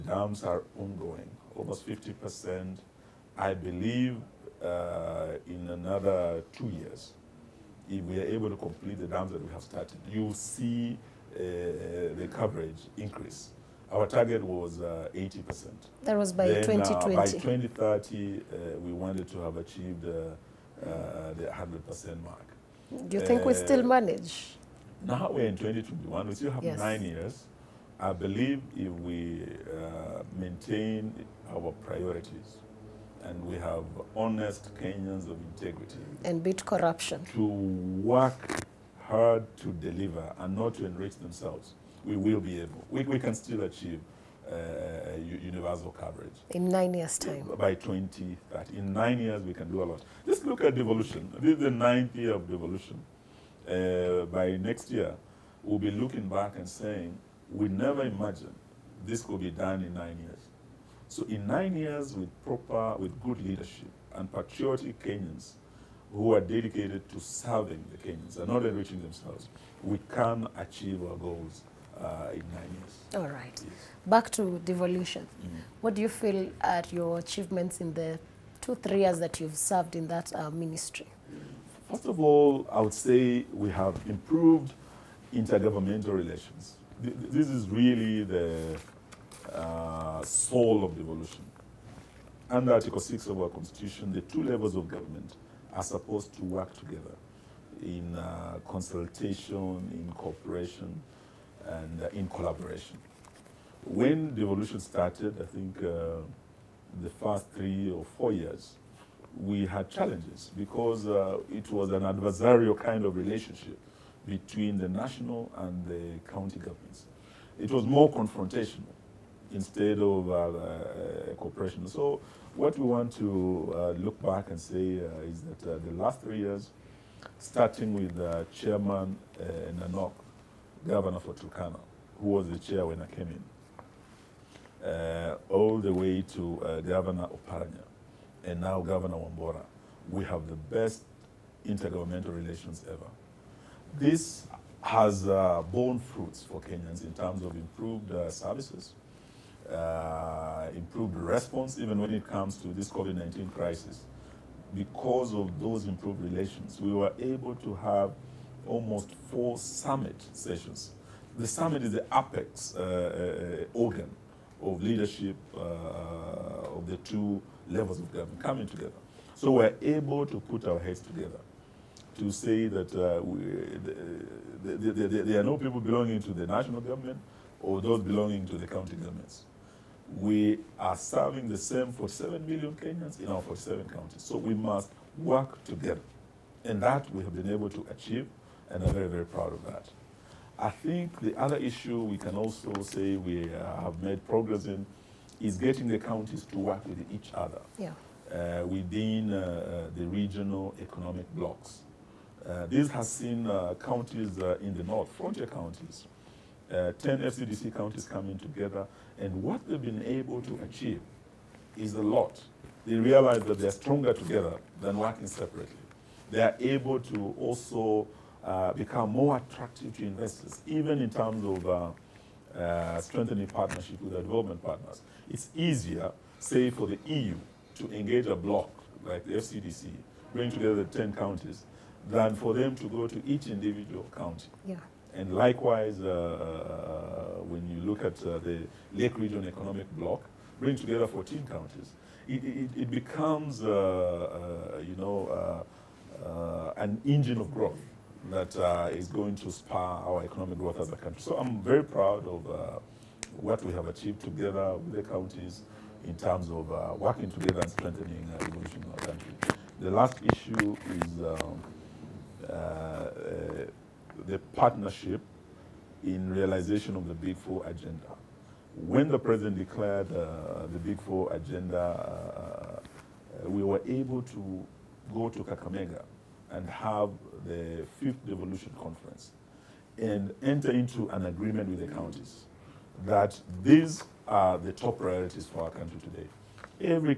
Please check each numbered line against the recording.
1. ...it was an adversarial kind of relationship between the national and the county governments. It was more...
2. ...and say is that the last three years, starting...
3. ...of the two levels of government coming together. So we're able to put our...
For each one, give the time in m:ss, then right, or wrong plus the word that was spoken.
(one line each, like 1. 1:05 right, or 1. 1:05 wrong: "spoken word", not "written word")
1. 1:51 right
2. 2:04 right
3. 2:46 right.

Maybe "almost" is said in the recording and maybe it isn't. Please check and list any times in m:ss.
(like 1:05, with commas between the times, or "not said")
0:01, 2:38.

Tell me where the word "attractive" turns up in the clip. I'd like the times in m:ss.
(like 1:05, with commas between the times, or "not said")
3:39.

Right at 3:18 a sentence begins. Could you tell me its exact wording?
uh, within uh, uh the regional economic blocks.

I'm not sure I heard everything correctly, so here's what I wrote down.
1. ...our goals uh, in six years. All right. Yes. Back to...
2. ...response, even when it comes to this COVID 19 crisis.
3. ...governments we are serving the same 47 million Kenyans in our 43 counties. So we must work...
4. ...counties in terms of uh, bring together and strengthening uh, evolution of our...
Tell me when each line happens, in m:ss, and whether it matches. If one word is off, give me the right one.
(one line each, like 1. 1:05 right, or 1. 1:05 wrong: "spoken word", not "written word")
1. 1:11 wrong: "nine", not "six"
2. 2:31 right
3. 2:58 wrong: "47", not "43"
4. 4:15 wrong: "working", not "bring".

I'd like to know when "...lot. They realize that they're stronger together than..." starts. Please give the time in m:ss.
3:32.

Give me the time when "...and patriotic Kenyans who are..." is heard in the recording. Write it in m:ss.
1:04.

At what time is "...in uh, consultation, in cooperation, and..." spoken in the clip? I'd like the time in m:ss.
1:37.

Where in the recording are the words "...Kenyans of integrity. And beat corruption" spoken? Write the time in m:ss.
0:34.